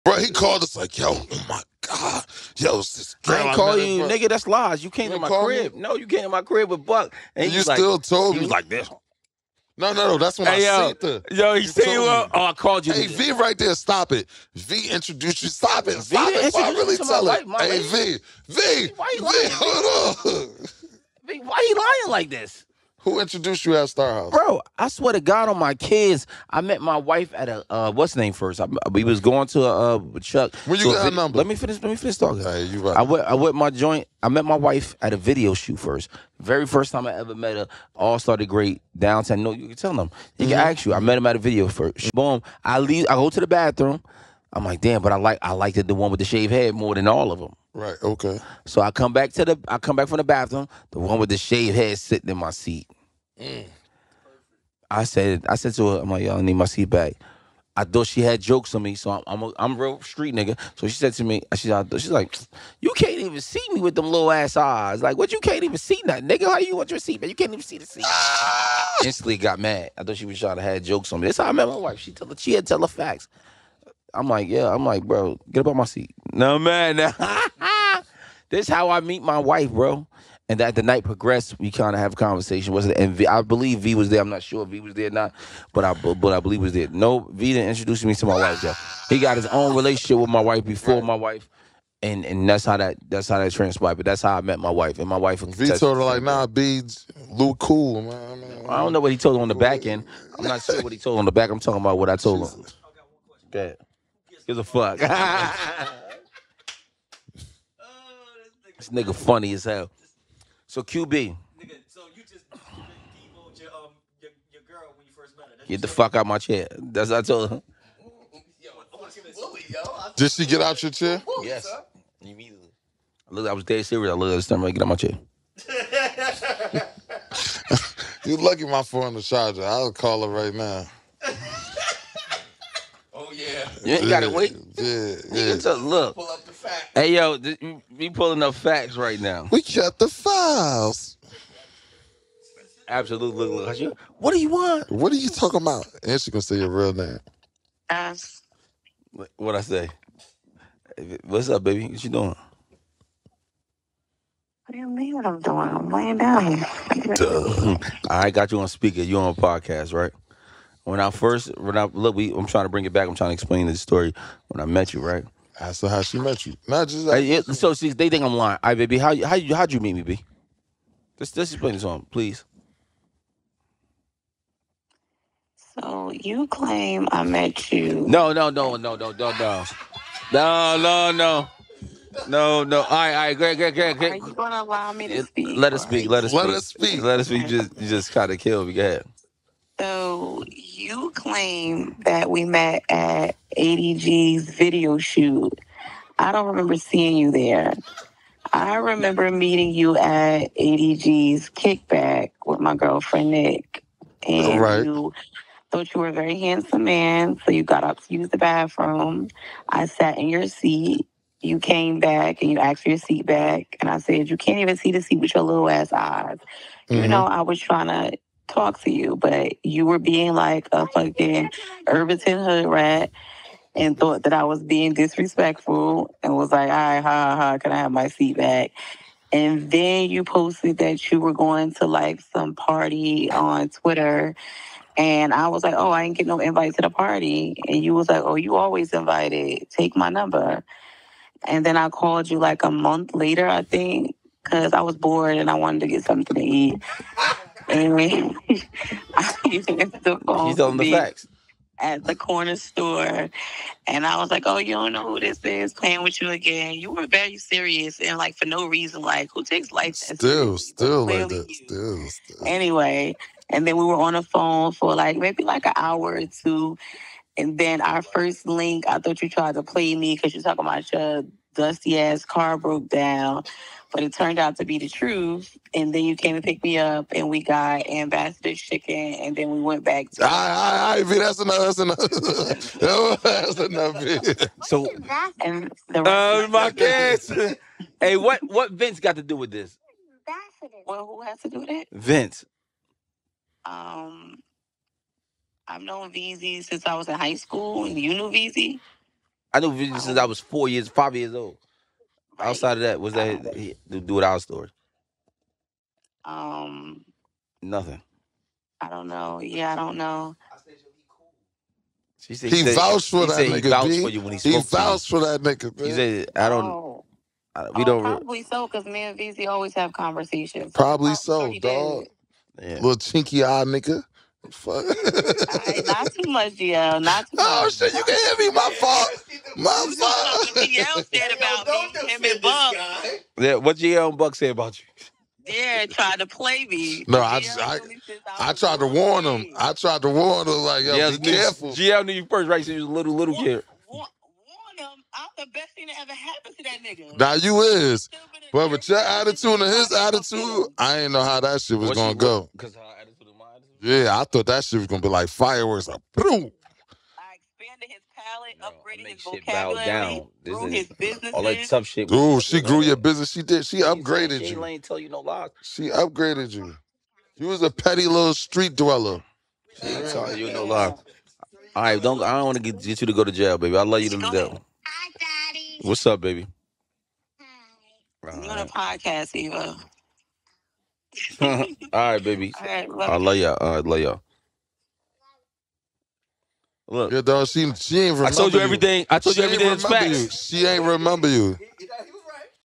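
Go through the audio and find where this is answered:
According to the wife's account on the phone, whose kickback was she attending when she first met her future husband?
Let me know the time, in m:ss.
3:20.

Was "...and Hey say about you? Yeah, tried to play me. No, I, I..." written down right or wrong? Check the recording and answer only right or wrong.
wrong.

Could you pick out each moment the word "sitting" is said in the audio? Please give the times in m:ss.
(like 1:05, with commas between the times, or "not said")
0:51.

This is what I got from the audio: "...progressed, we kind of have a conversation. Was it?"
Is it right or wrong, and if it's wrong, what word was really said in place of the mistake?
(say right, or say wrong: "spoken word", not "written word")
right.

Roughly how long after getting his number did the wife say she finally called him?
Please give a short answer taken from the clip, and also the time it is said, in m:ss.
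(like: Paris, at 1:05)
a month later, at 4:02.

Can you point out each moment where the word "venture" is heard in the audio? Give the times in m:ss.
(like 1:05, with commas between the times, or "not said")
not said.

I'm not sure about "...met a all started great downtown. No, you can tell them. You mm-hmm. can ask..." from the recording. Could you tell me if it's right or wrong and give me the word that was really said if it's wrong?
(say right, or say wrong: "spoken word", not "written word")
right.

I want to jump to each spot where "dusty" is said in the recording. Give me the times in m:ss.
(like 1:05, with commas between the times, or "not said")
4:31.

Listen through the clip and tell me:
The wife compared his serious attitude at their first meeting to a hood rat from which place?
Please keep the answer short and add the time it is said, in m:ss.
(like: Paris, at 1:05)
Irvington, at 3:41.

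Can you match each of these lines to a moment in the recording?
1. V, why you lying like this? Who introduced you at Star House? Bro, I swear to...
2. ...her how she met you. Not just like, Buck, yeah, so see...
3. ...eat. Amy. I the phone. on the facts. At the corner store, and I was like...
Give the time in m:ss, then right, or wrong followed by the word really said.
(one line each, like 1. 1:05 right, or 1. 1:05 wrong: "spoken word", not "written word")
1. 0:21 right
2. 2:45 wrong: "Hey", not "Buck"
3. 4:06 right.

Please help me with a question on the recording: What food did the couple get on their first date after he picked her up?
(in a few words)
ambassador chicken.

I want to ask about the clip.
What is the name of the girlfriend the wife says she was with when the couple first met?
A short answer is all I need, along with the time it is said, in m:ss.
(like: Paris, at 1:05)
Nick, at 3:23.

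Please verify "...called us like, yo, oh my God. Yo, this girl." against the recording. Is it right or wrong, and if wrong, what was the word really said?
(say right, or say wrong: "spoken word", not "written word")
right.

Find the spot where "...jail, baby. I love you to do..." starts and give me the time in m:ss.
6:13.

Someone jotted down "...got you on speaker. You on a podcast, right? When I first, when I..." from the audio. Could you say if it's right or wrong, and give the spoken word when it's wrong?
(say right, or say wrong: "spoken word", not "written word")
right.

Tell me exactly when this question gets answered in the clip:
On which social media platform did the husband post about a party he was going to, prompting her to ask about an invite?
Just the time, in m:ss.
3:53.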